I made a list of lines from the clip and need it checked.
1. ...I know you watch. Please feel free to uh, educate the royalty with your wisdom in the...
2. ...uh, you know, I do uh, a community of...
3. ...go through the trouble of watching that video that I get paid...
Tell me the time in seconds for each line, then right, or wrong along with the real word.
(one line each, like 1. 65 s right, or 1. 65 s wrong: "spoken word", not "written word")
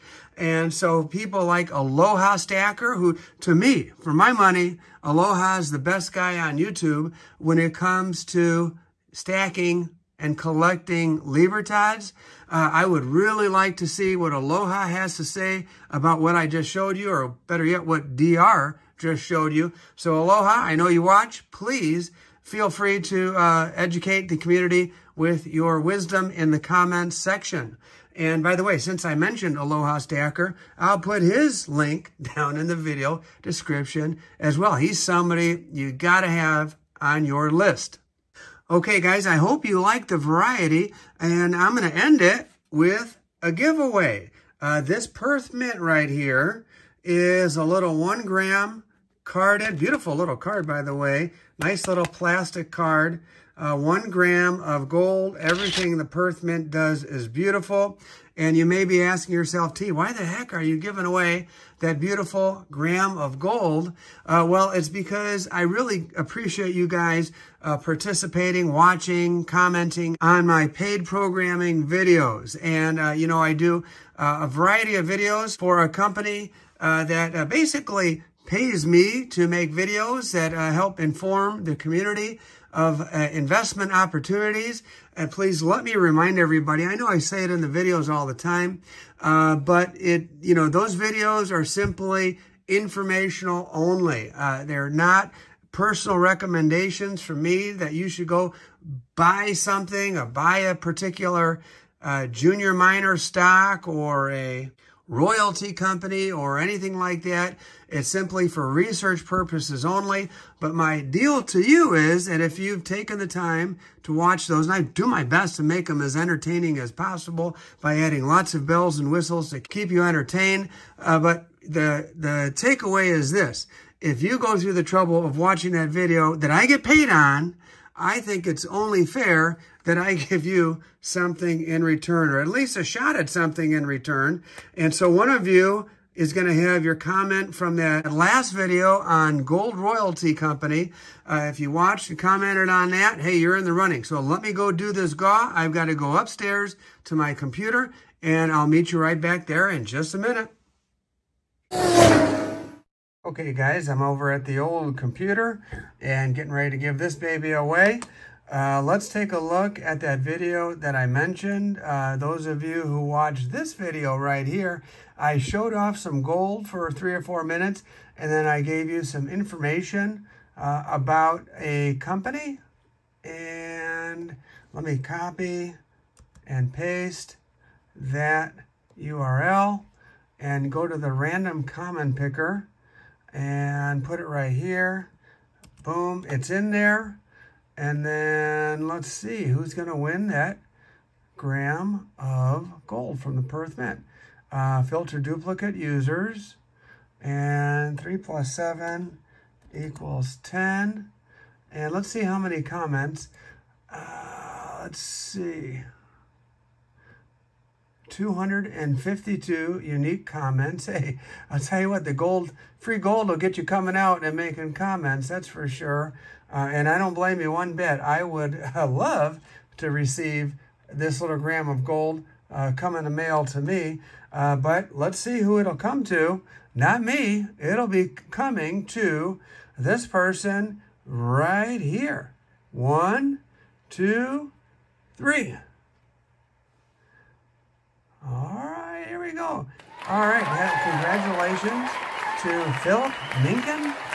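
1. 20 s wrong: "community", not "royalty"
2. 72 s wrong: "variety", not "community"
3. 124 s right.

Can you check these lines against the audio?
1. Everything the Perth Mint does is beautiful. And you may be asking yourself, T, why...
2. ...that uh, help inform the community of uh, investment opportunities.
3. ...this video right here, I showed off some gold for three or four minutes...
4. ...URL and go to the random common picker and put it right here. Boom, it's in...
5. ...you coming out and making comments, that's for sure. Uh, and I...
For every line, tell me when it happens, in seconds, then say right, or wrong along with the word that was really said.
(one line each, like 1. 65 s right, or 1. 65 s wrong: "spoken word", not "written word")
1. 55 s right
2. 80 s right
3. 163 s right
4. 178 s right
5. 213 s right.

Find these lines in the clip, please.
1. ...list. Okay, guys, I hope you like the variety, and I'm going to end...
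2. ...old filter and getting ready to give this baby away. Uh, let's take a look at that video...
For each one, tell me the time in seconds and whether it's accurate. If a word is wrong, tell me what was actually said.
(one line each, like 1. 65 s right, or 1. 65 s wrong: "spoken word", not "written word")
1. 37 s right
2. 154 s wrong: "computer", not "filter".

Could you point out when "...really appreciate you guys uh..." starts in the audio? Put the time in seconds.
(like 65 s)
65 s.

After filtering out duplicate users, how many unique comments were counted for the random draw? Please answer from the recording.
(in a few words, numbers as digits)
252.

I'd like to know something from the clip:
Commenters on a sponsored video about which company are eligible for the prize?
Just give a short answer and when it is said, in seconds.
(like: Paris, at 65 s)
Gold Royalty Company, at 139 s.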